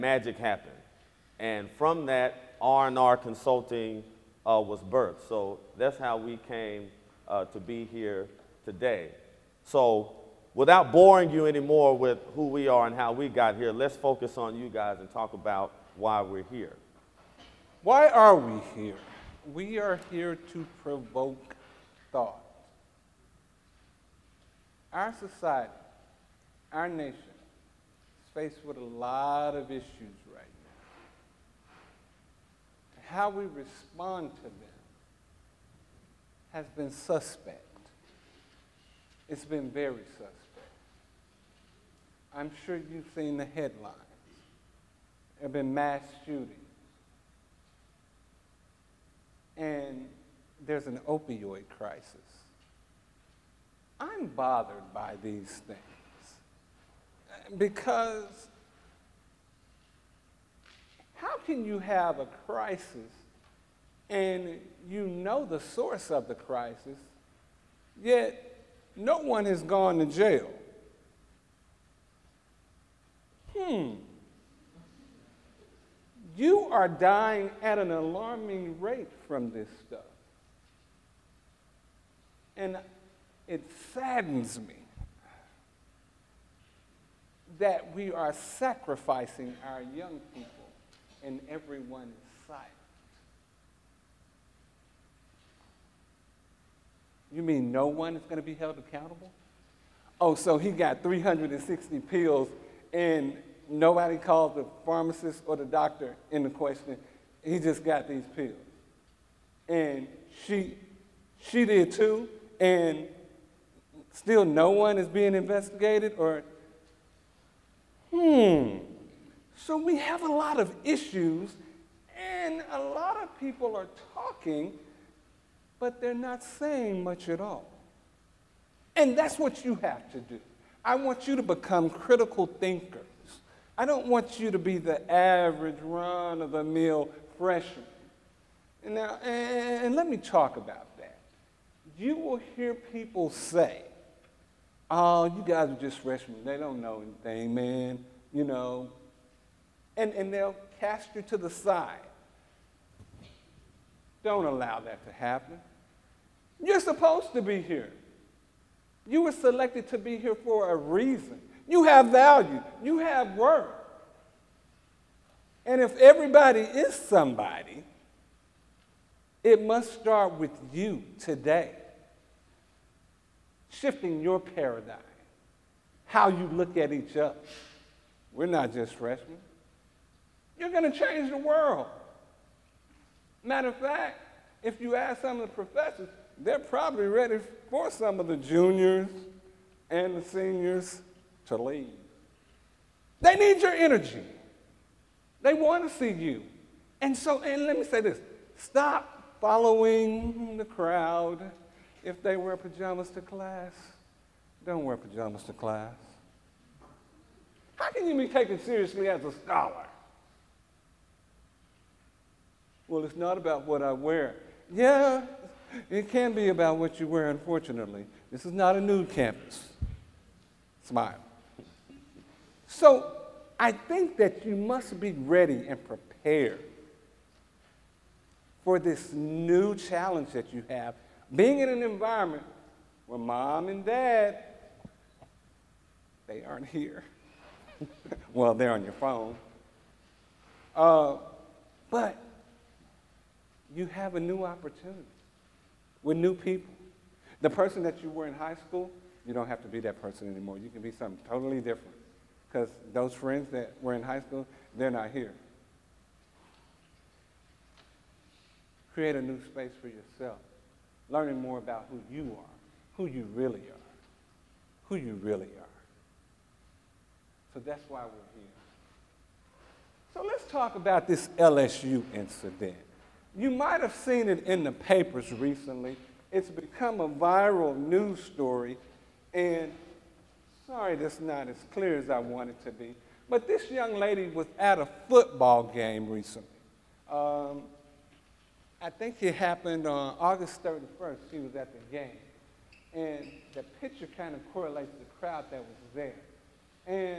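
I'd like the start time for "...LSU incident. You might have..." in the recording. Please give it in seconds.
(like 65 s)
271 s.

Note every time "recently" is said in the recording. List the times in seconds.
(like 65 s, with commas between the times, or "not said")
275 s, 286 s.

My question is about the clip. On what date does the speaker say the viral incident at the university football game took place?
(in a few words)
August 31st.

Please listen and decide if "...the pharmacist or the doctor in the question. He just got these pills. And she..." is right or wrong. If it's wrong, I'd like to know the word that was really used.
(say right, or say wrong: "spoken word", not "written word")
right.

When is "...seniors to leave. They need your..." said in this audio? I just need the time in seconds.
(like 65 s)
190 s.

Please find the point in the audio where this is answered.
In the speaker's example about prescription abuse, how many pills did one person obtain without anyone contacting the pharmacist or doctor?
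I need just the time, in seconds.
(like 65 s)
101 s.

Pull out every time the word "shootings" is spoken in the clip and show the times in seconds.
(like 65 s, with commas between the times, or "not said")
46 s.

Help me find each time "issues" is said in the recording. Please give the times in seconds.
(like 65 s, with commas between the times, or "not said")
29 s, 120 s.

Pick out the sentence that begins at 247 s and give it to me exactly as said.
The person that you were in high school, you don't have to be that person anymore.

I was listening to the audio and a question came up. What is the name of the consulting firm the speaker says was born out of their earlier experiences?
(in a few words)
R&R Consulting.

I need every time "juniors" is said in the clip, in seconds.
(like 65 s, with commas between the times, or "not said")
188 s.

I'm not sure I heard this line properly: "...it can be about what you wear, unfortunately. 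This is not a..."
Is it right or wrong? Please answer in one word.
right.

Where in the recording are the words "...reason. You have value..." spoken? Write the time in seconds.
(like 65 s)
160 s.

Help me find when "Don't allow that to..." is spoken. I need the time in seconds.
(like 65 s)
154 s.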